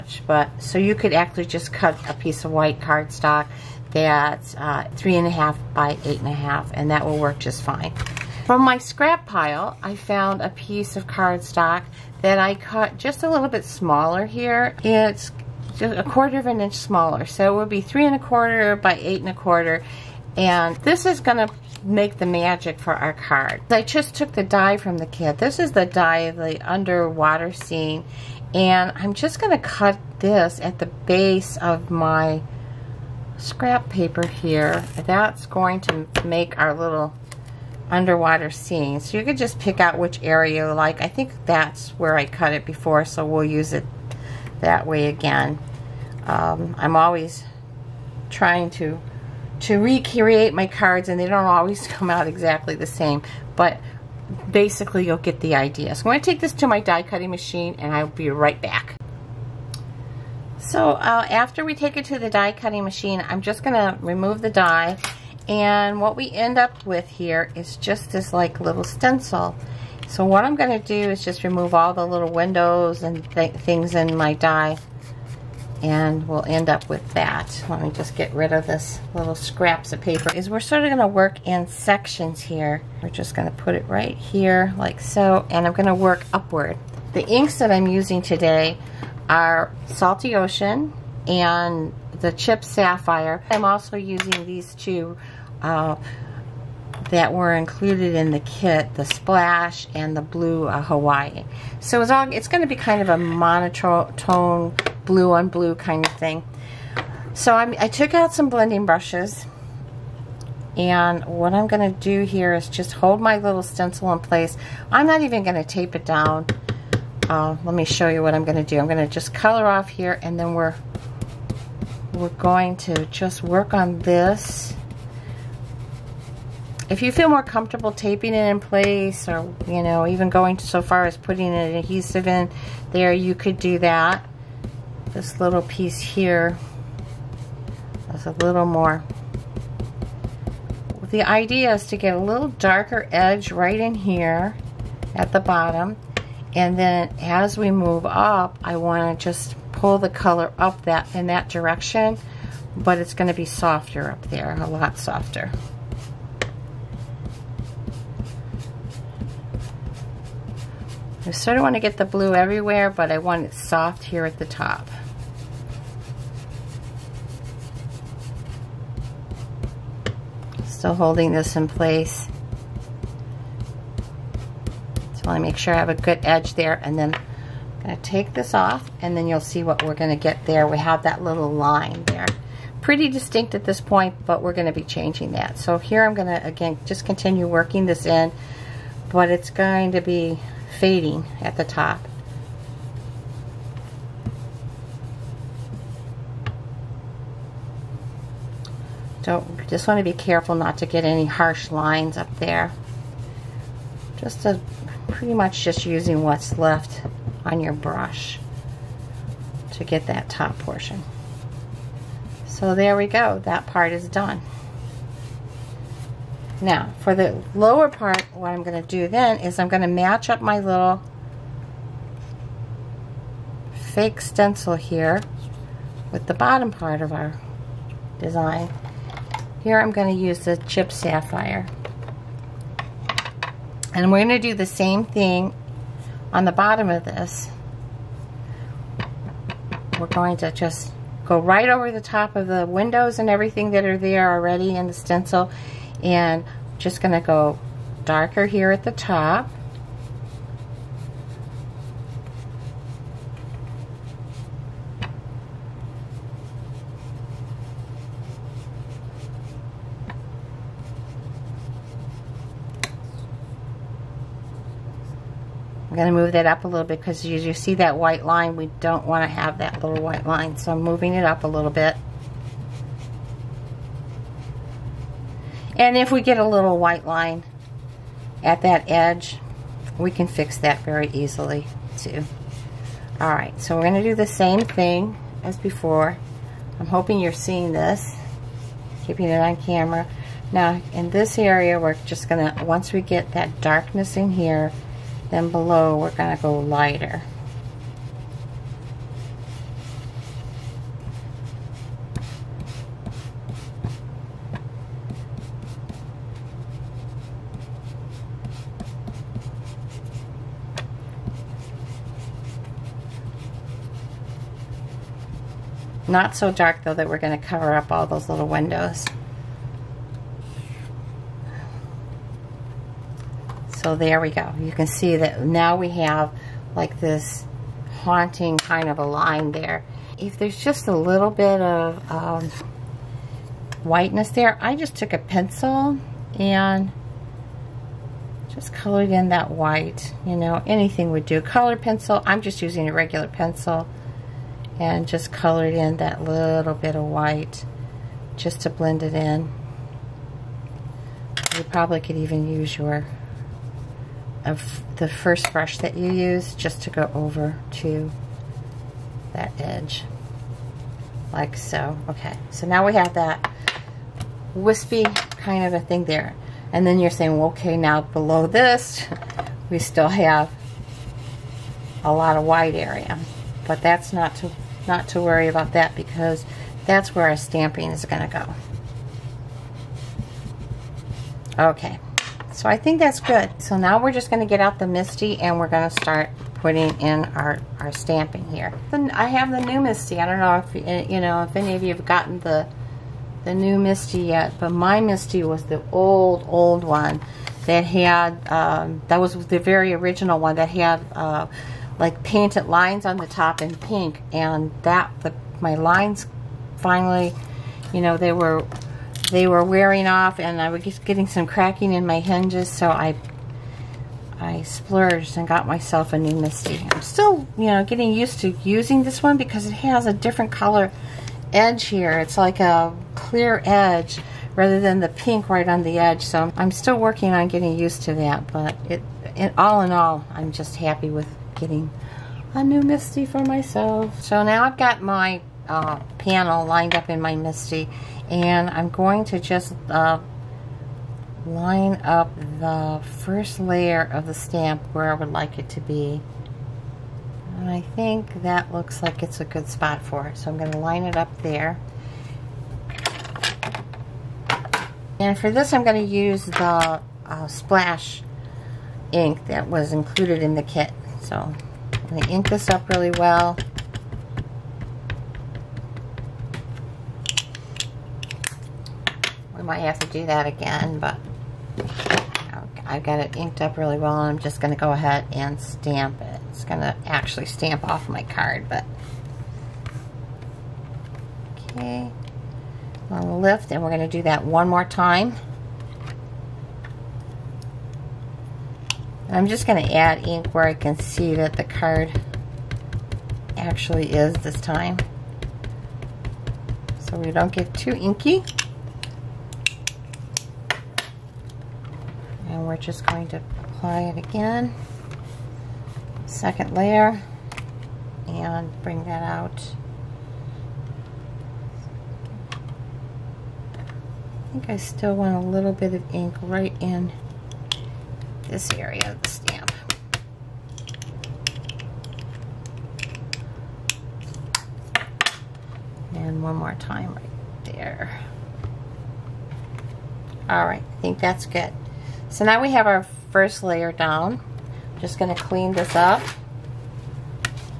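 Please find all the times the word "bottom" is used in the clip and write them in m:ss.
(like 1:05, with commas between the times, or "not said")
2:25, 3:46, 3:56.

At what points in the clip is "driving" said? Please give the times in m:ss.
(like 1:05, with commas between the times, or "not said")
not said.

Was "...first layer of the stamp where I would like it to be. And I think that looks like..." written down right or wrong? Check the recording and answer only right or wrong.
right.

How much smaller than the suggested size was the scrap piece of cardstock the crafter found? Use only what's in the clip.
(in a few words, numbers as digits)
A quarter of an inch.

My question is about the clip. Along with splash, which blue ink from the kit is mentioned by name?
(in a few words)
Hawaii.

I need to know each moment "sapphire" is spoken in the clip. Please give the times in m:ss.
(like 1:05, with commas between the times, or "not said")
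1:32, 3:50.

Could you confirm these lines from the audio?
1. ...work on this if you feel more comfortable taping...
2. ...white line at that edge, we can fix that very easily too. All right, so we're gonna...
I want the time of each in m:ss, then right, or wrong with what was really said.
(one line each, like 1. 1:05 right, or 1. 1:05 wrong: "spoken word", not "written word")
1. 2:03 right
2. 4:36 right.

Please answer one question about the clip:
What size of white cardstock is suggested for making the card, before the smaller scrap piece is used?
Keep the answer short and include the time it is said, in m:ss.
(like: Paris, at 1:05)
3.5 by 8.5, at 0:04.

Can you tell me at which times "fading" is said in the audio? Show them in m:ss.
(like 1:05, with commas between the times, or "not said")
3:10.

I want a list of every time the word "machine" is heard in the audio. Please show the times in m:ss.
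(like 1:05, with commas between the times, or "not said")
0:57, 1:02.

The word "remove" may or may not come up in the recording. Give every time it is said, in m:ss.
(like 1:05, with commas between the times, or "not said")
1:04, 1:11.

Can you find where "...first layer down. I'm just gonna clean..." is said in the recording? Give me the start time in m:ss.
8:53.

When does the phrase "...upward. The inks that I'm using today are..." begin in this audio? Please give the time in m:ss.
1:26.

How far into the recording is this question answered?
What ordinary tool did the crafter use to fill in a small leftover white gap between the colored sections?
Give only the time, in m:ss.
5:42.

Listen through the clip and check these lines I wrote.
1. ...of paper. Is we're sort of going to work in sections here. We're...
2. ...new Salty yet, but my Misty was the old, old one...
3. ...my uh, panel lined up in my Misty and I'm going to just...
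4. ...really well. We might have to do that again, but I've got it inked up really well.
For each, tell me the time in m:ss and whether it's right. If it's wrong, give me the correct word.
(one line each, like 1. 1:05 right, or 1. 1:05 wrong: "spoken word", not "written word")
1. 1:19 right
2. 6:33 wrong: "Misty", not "Salty"
3. 7:15 right
4. 7:42 right.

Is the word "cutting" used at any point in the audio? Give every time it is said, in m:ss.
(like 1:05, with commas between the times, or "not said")
0:57, 1:02.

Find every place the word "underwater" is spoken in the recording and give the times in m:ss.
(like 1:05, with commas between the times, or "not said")
0:26, 0:37.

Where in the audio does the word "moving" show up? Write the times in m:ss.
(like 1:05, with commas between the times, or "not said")
4:30.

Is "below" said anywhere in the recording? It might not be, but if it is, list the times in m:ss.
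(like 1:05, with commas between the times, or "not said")
4:55, 6:08.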